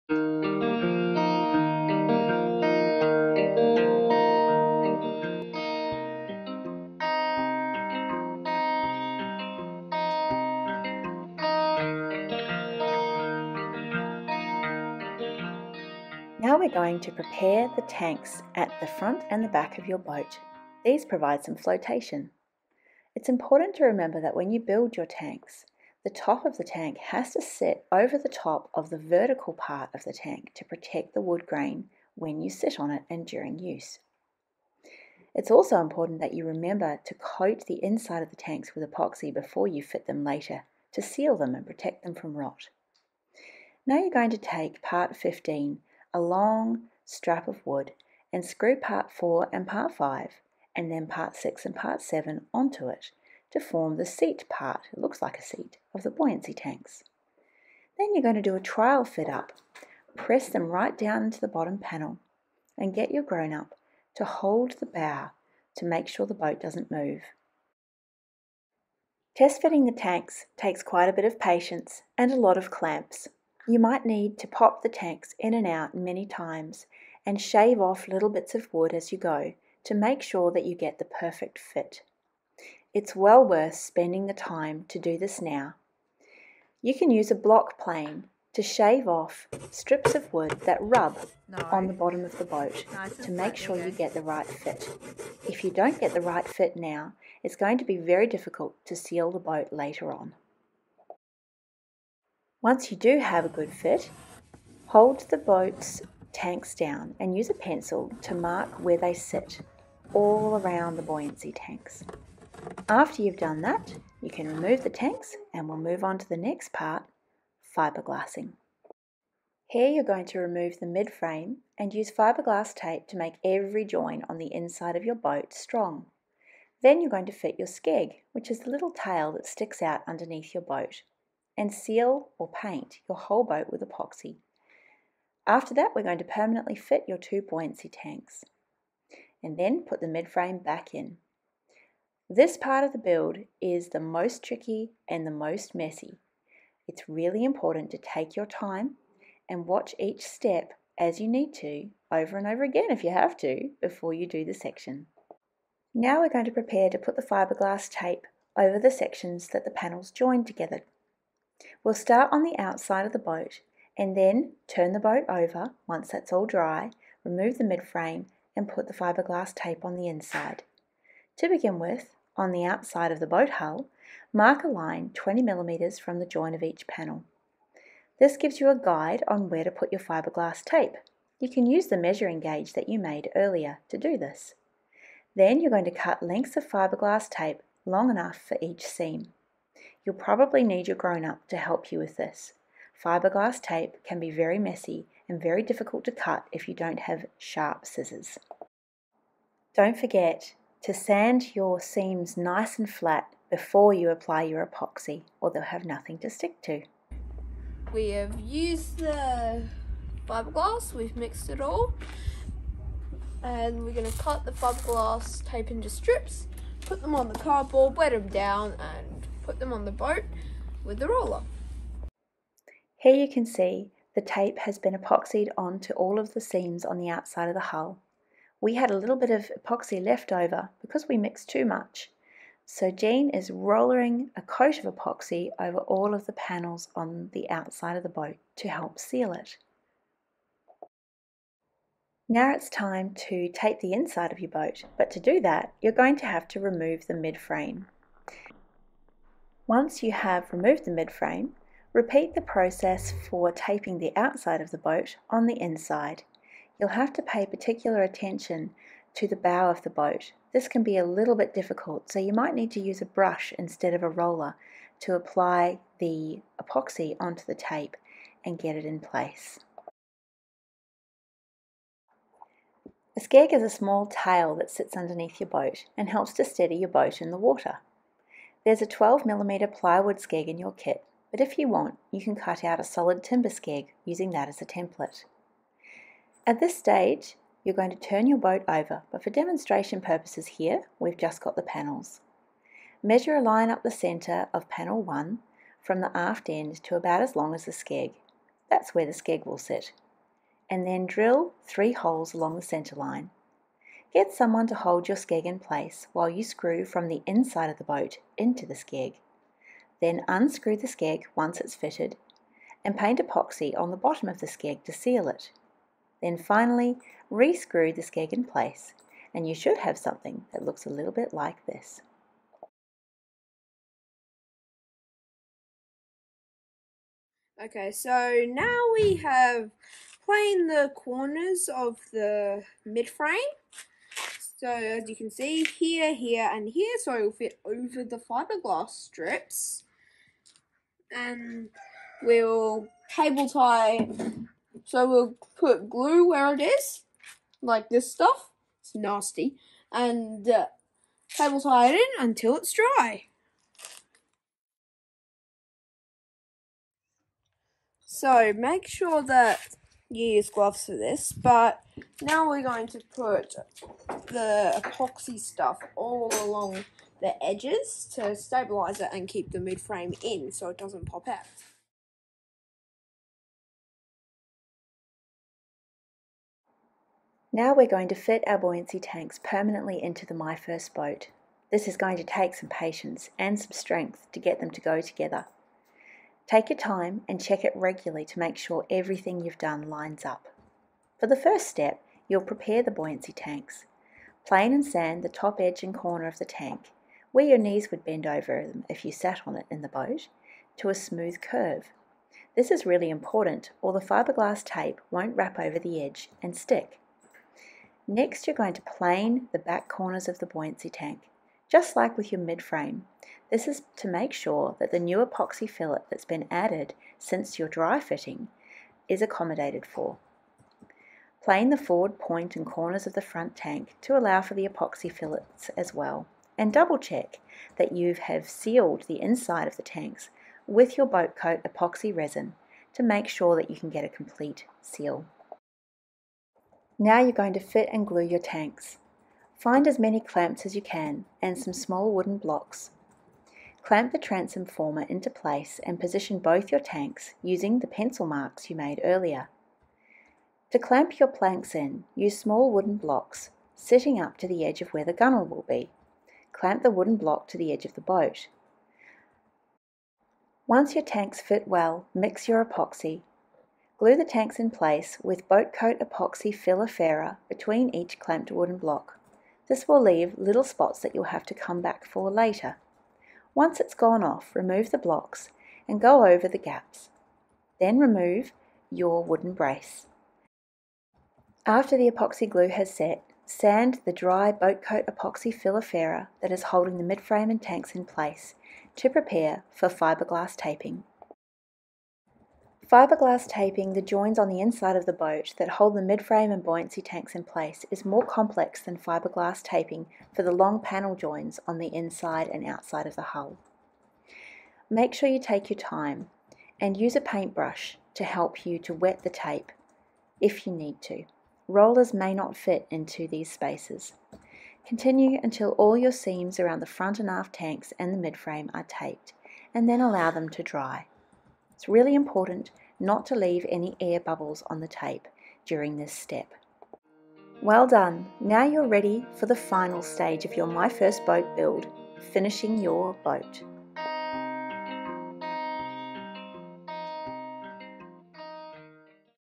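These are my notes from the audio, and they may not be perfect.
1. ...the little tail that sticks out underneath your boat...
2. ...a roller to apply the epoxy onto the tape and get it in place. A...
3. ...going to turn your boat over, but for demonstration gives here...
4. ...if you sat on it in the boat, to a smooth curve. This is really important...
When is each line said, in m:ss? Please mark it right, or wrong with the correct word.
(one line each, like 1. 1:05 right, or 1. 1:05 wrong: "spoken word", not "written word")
1. 2:08 right
2. 4:24 right
3. 4:47 wrong: "purposes", not "gives"
4. 6:38 right.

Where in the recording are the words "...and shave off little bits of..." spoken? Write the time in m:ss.
1:17.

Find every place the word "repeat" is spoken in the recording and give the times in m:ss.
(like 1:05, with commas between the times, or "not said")
4:11.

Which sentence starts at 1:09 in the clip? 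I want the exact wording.
Test fitting the tanks takes quite a bit of patience and a lot of clamps.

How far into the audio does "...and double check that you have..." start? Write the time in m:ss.
7:06.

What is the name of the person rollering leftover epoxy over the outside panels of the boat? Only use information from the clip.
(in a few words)
Jean.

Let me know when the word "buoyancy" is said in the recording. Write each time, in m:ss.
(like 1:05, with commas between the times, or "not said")
0:56, 1:51, 2:17, 6:18, 6:32, 6:50, 8:16.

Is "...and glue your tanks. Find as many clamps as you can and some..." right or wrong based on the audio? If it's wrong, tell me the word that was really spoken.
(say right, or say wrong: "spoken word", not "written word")
right.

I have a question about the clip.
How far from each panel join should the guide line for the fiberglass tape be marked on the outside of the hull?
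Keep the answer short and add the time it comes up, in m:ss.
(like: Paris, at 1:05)
20mm, at 2:55.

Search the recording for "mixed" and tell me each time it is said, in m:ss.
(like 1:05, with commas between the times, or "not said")
3:31, 3:51.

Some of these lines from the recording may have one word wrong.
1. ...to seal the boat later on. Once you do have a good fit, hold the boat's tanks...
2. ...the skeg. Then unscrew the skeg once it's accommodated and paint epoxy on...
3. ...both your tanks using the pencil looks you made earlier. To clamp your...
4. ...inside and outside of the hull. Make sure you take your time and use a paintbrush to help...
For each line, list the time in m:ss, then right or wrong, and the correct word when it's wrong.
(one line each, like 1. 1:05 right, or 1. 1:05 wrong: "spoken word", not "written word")
1. 1:38 right
2. 5:08 wrong: "fitted", not "accommodated"
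3. 7:26 wrong: "marks", not "looks"
4. 8:21 right.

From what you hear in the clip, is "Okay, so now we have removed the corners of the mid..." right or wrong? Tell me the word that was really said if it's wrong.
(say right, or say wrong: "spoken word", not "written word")
wrong: "planed", not "removed".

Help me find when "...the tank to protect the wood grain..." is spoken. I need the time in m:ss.
0:30.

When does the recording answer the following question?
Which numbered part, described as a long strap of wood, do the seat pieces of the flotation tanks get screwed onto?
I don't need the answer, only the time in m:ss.
0:44.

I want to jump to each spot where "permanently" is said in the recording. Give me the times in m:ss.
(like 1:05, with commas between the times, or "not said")
2:16, 6:19.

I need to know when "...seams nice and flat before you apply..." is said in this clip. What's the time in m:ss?
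3:21.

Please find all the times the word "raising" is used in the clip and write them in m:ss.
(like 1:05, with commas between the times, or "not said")
not said.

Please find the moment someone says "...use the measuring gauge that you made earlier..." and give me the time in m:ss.
3:01.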